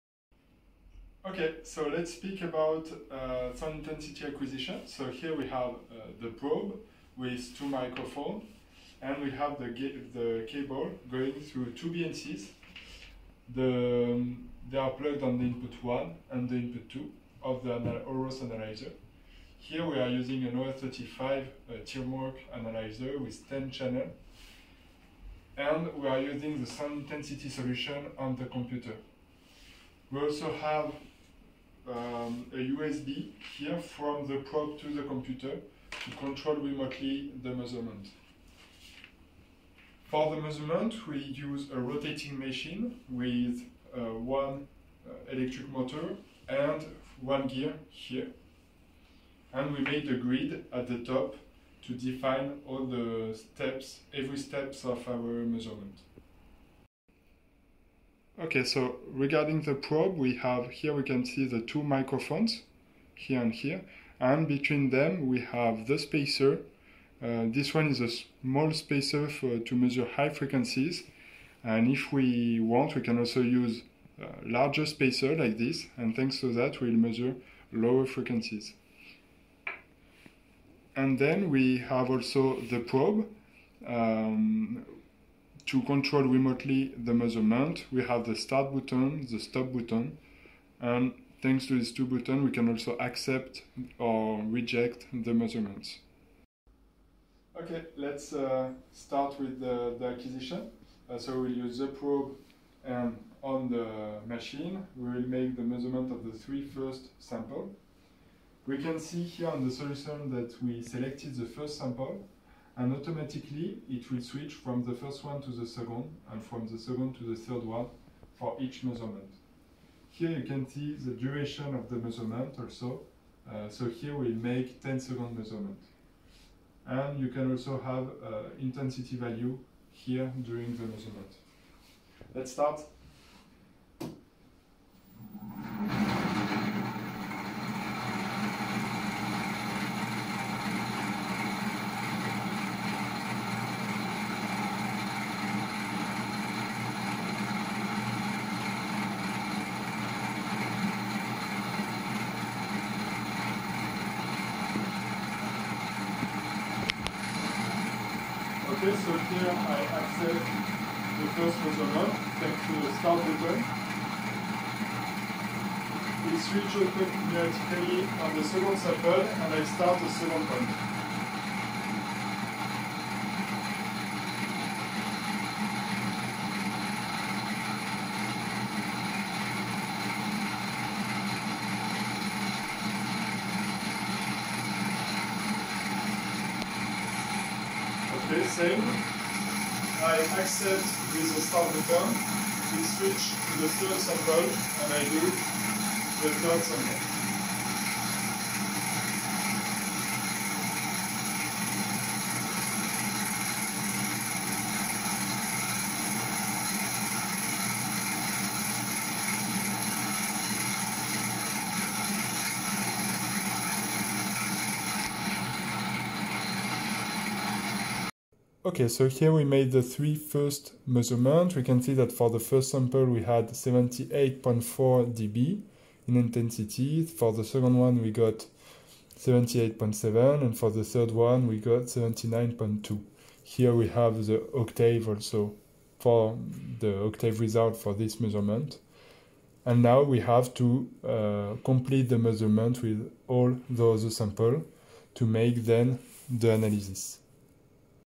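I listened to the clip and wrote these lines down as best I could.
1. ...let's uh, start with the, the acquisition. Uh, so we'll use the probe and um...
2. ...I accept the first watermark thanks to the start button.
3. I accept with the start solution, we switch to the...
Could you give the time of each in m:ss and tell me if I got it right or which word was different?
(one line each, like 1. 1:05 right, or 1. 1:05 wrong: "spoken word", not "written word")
1. 1:37 right
2. 2:39 right
3. 3:10 wrong: "button", not "solution".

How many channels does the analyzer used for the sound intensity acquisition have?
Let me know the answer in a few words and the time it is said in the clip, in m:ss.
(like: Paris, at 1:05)
10, at 0:23.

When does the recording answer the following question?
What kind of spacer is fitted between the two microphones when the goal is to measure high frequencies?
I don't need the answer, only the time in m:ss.
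1:08.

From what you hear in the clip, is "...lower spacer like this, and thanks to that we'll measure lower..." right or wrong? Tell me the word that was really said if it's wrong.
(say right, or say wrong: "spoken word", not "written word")
wrong: "larger", not "lower".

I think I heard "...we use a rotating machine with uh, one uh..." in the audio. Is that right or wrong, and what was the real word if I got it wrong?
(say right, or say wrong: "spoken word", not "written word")
right.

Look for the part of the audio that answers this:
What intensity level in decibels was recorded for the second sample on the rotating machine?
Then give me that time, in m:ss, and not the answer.
3:49.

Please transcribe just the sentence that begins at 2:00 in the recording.
Here you can see the duration of the measurement also, uh, so here we make 10 second measurement.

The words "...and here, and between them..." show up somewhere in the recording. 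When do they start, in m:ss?
1:03.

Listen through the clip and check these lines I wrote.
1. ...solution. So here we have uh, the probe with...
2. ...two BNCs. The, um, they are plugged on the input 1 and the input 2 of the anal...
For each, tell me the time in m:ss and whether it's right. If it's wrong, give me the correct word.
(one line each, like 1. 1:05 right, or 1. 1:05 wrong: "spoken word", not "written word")
1. 0:04 wrong: "acquisition", not "solution"
2. 0:11 right.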